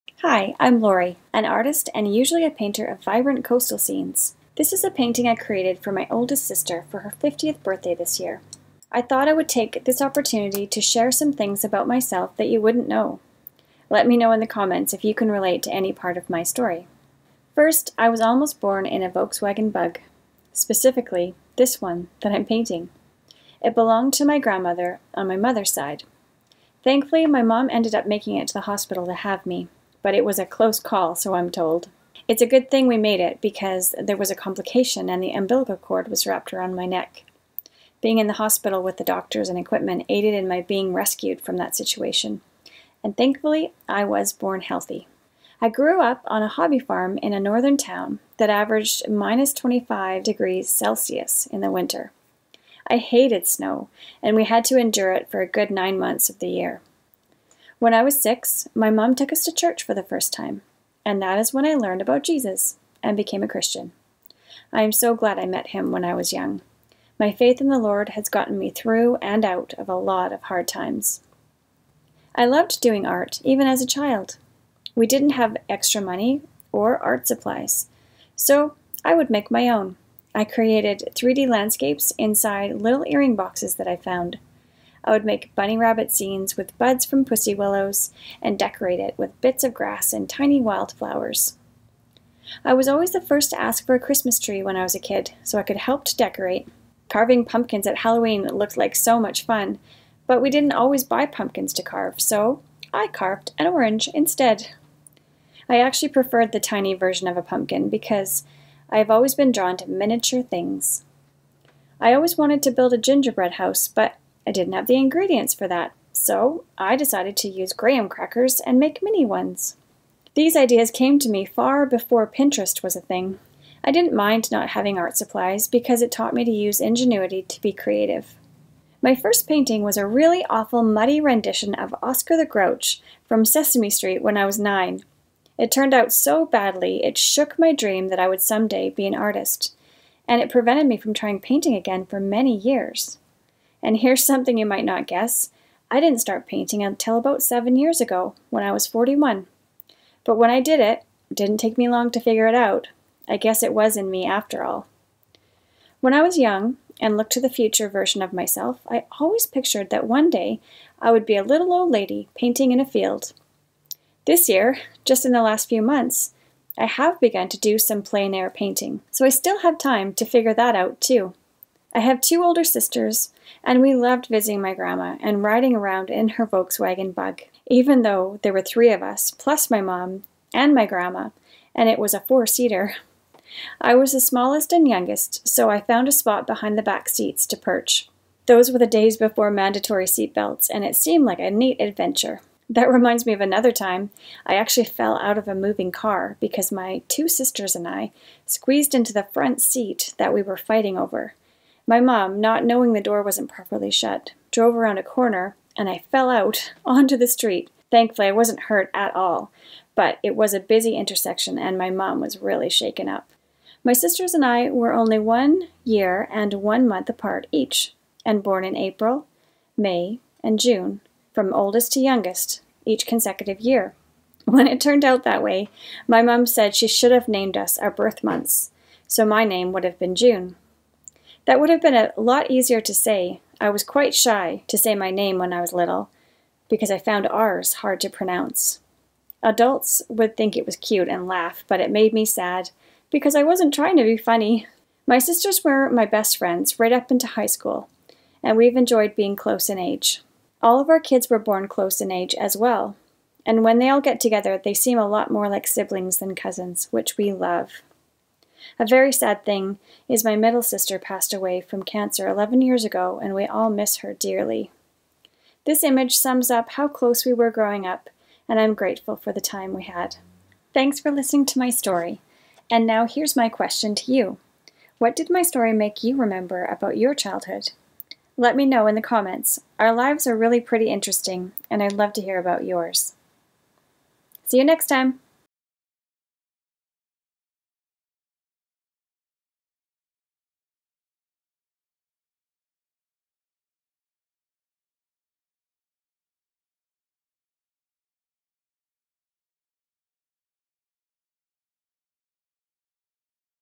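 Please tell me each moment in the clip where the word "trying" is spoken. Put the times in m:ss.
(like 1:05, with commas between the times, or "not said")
2:21, 4:03.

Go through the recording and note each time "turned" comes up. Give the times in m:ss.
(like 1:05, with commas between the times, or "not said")
2:15, 3:44.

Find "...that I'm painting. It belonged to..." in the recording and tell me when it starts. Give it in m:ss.
0:22.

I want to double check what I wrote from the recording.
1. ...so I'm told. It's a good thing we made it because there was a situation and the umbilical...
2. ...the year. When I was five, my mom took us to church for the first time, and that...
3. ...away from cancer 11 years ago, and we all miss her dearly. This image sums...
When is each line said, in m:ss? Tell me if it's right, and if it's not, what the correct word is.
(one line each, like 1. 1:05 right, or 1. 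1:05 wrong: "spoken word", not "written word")
1. 0:31 wrong: "complication", not "situation"
2. 0:56 wrong: "six", not "five"
3. 4:21 right.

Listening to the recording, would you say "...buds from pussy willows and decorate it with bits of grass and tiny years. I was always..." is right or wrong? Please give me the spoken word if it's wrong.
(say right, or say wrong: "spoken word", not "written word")
wrong: "wildflowers", not "years".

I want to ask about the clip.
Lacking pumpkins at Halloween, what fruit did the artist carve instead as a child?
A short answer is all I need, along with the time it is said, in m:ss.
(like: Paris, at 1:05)
An orange, at 1:43.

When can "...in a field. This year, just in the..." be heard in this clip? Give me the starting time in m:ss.
2:42.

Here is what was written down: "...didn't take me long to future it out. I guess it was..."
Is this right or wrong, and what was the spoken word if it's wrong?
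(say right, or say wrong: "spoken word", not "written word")
wrong: "figure", not "future".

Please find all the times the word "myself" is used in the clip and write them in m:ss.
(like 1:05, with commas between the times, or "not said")
0:11, 2:38.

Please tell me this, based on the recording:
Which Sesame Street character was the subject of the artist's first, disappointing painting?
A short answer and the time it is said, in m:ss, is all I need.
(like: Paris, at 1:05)
Oscar the Grouch, at 2:12.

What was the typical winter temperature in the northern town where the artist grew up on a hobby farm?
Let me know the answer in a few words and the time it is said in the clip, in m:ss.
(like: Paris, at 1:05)
-25 degrees Celsius, at 0:49.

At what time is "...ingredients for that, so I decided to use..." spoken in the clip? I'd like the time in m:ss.
1:54.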